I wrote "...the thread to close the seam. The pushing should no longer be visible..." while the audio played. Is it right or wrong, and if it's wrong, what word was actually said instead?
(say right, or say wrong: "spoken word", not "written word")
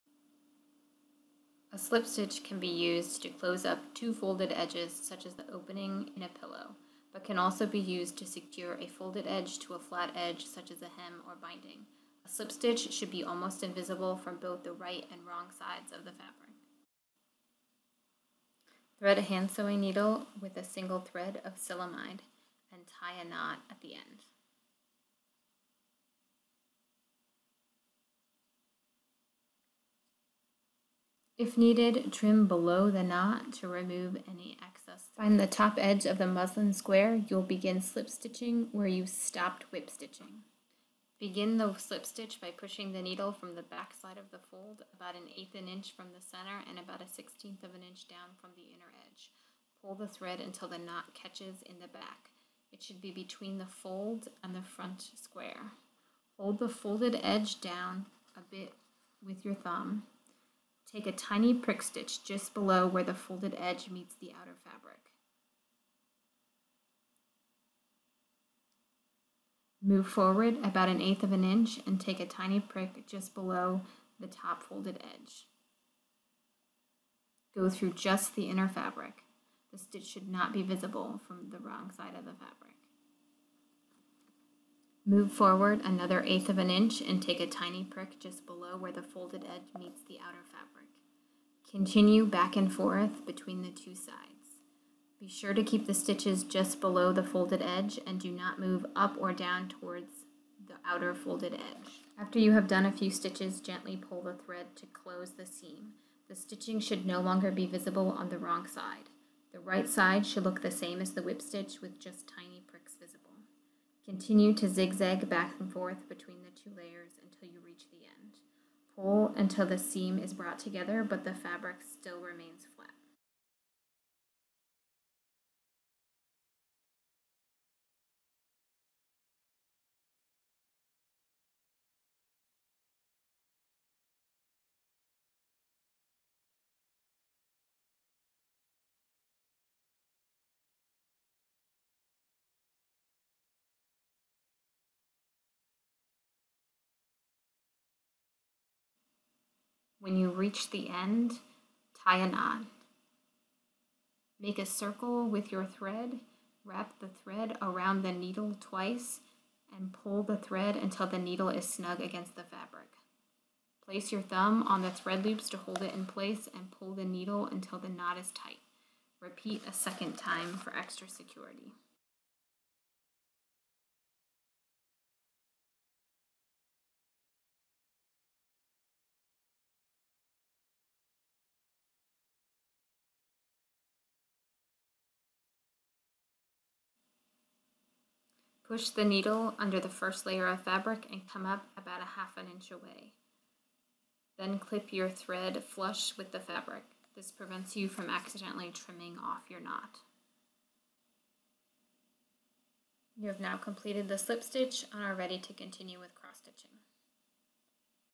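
wrong: "stitching", not "pushing".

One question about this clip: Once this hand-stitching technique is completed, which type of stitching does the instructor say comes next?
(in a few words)
cross stitching.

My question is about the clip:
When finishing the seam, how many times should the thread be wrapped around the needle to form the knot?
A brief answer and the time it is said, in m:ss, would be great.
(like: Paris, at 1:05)
twice, at 2:38.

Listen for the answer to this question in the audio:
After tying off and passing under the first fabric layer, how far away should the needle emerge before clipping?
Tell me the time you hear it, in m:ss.
3:12.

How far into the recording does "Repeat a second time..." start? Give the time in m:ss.
2:49.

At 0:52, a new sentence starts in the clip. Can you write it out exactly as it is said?
It should be between the fold and the front square.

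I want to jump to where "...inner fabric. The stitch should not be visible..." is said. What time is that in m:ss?
1:18.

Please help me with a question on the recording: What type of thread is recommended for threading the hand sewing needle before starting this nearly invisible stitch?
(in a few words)
silamide.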